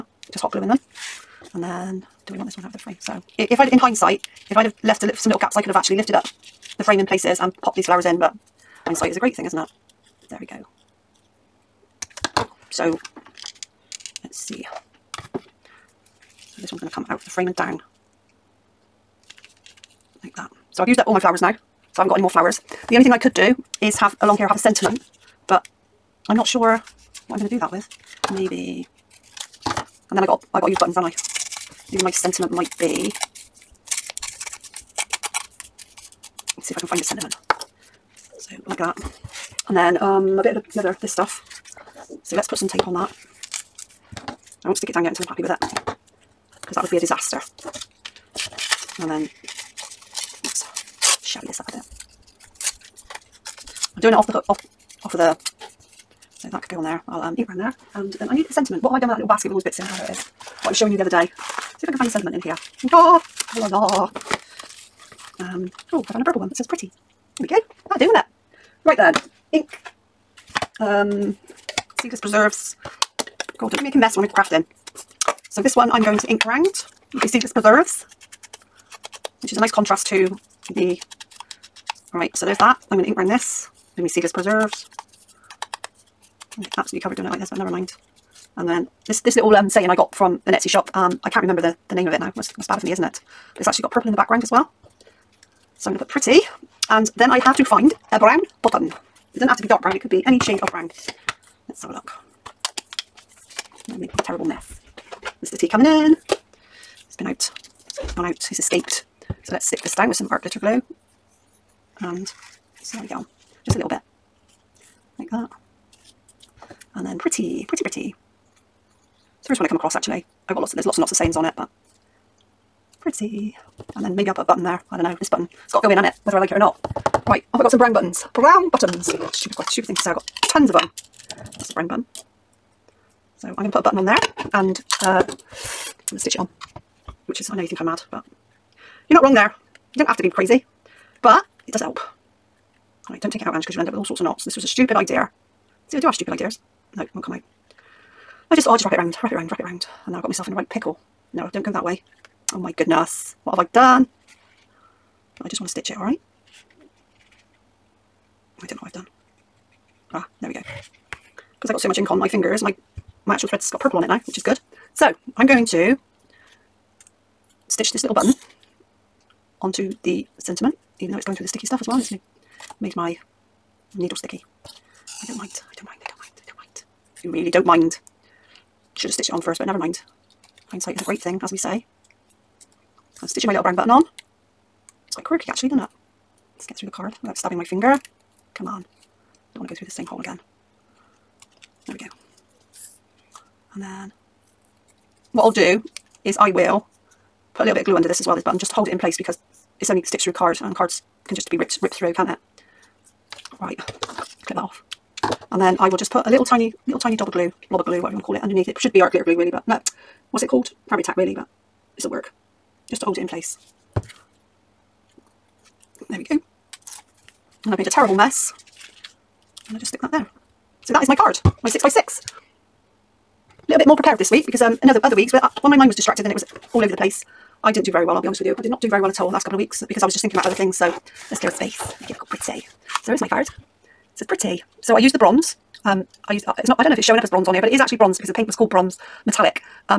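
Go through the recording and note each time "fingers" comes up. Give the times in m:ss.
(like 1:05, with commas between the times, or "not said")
2:42, 3:07.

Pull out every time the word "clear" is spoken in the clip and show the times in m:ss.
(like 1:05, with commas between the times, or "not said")
3:51.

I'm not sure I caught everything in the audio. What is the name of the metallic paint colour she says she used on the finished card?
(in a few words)
Bronze metallic.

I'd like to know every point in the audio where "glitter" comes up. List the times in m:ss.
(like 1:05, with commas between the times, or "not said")
1:50, 3:29.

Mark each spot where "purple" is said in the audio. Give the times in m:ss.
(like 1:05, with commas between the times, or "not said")
1:06, 1:33, 2:43.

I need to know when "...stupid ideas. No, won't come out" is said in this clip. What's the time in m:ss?
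2:26.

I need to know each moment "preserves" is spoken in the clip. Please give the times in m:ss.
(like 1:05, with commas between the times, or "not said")
1:12, 1:17, 1:24.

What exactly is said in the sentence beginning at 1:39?
It doesn't have to be dark brown, it could be any shade of brown.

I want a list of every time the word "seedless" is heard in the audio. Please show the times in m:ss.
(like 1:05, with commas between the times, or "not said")
1:12, 1:17, 1:24.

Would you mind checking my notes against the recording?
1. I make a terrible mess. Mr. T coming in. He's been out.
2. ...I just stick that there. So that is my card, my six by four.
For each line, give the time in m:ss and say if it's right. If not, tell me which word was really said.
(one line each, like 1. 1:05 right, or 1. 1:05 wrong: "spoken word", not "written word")
1. 1:43 right
2. 3:39 wrong: "six", not "four".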